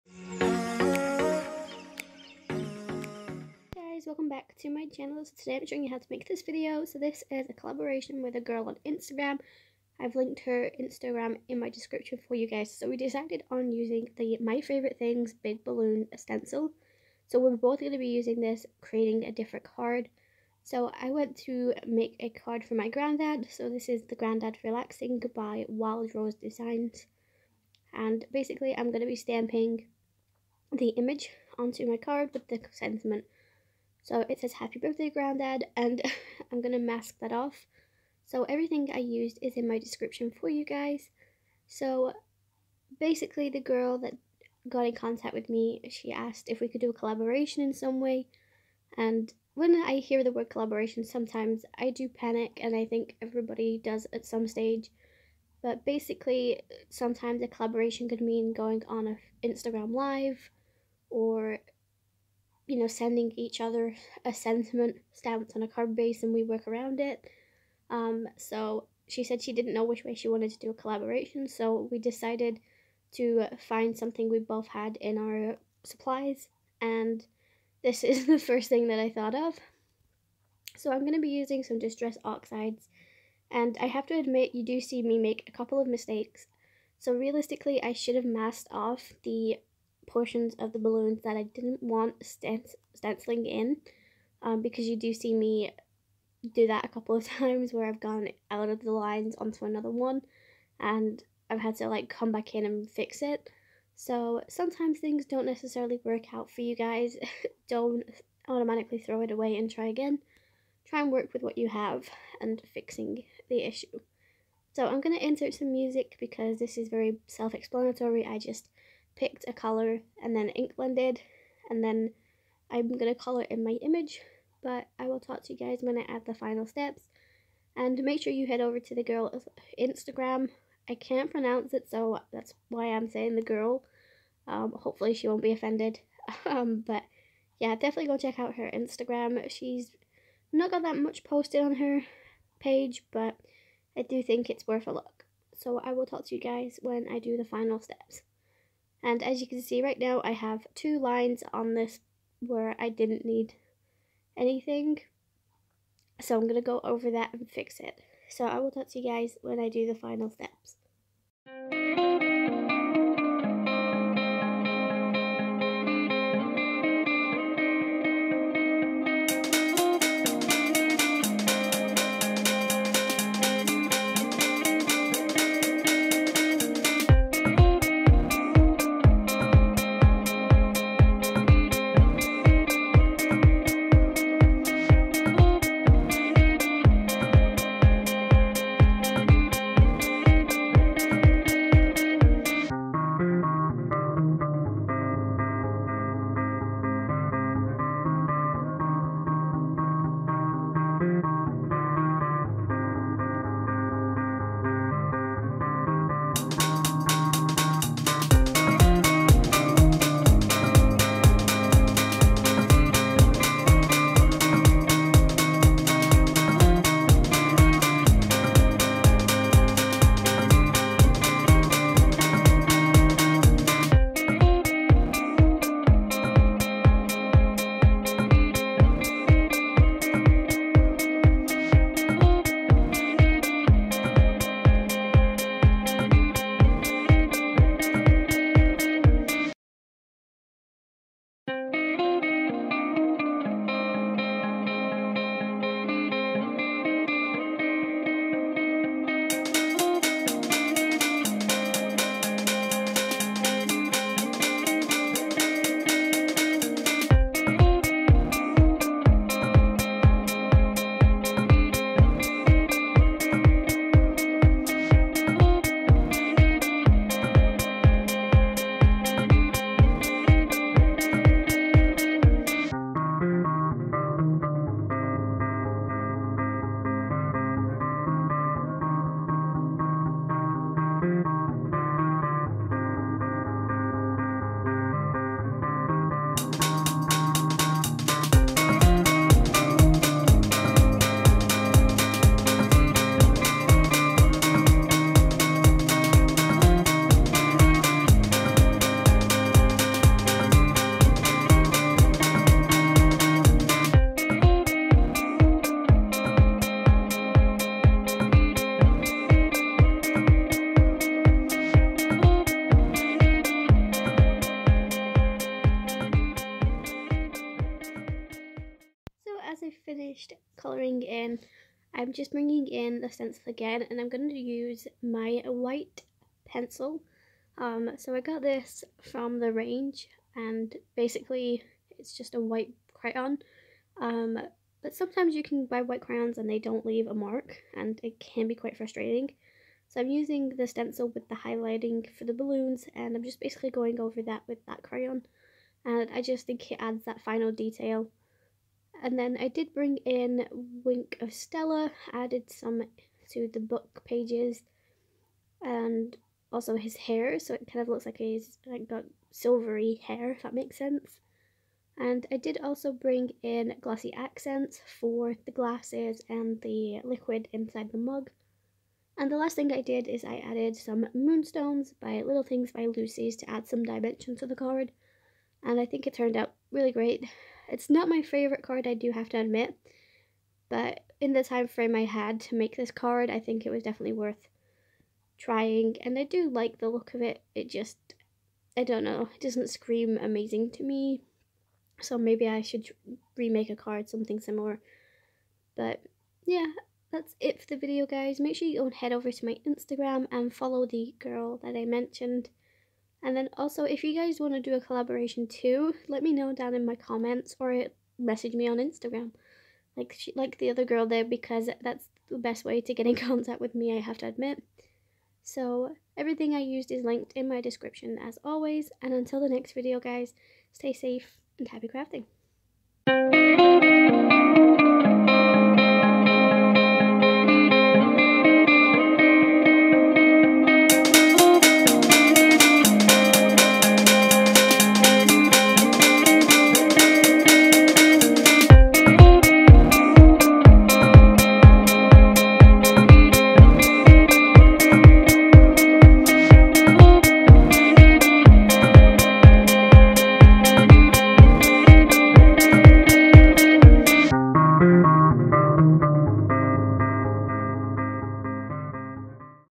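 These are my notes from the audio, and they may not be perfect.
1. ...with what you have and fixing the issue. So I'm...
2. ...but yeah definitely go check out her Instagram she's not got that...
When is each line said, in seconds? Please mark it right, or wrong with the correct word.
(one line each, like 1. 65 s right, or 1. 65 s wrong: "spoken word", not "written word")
1. 111 s right
2. 136 s right.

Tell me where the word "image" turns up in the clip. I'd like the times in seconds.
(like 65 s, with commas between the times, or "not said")
30 s, 123 s.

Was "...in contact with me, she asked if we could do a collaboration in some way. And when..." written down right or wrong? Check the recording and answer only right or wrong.
right.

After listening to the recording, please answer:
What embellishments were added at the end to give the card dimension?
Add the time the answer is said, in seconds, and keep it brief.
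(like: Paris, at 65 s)
Moonstones, at 371 s.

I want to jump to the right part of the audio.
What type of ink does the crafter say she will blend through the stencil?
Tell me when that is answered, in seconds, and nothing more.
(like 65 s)
81 s.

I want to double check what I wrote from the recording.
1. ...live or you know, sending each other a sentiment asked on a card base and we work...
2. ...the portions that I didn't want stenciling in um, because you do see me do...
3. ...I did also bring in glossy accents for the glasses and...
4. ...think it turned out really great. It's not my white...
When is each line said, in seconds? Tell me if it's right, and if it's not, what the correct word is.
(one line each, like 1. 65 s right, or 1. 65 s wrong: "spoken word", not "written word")
1. 59 s wrong: "stamped", not "asked"
2. 90 s wrong: "balloons", not "portions"
3. 362 s right
4. 375 s wrong: "favorite", not "white".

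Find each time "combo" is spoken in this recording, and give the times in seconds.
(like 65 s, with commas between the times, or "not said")
not said.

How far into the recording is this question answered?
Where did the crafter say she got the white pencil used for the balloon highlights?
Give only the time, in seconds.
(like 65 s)
329 s.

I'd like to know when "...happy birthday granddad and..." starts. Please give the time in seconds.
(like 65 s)
34 s.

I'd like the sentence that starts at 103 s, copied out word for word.
So sometimes things don't necessarily work out for you guys.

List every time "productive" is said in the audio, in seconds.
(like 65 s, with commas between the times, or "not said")
not said.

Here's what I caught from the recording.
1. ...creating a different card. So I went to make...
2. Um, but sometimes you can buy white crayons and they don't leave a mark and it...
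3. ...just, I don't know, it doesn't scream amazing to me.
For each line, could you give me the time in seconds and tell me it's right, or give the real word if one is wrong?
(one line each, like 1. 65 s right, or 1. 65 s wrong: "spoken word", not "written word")
1. 18 s right
2. 334 s right
3. 387 s right.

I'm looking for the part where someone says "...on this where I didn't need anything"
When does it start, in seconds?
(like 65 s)
151 s.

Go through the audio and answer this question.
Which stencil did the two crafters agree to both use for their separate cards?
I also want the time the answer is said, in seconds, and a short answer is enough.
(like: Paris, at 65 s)
Big Balloon stencil, at 15 s.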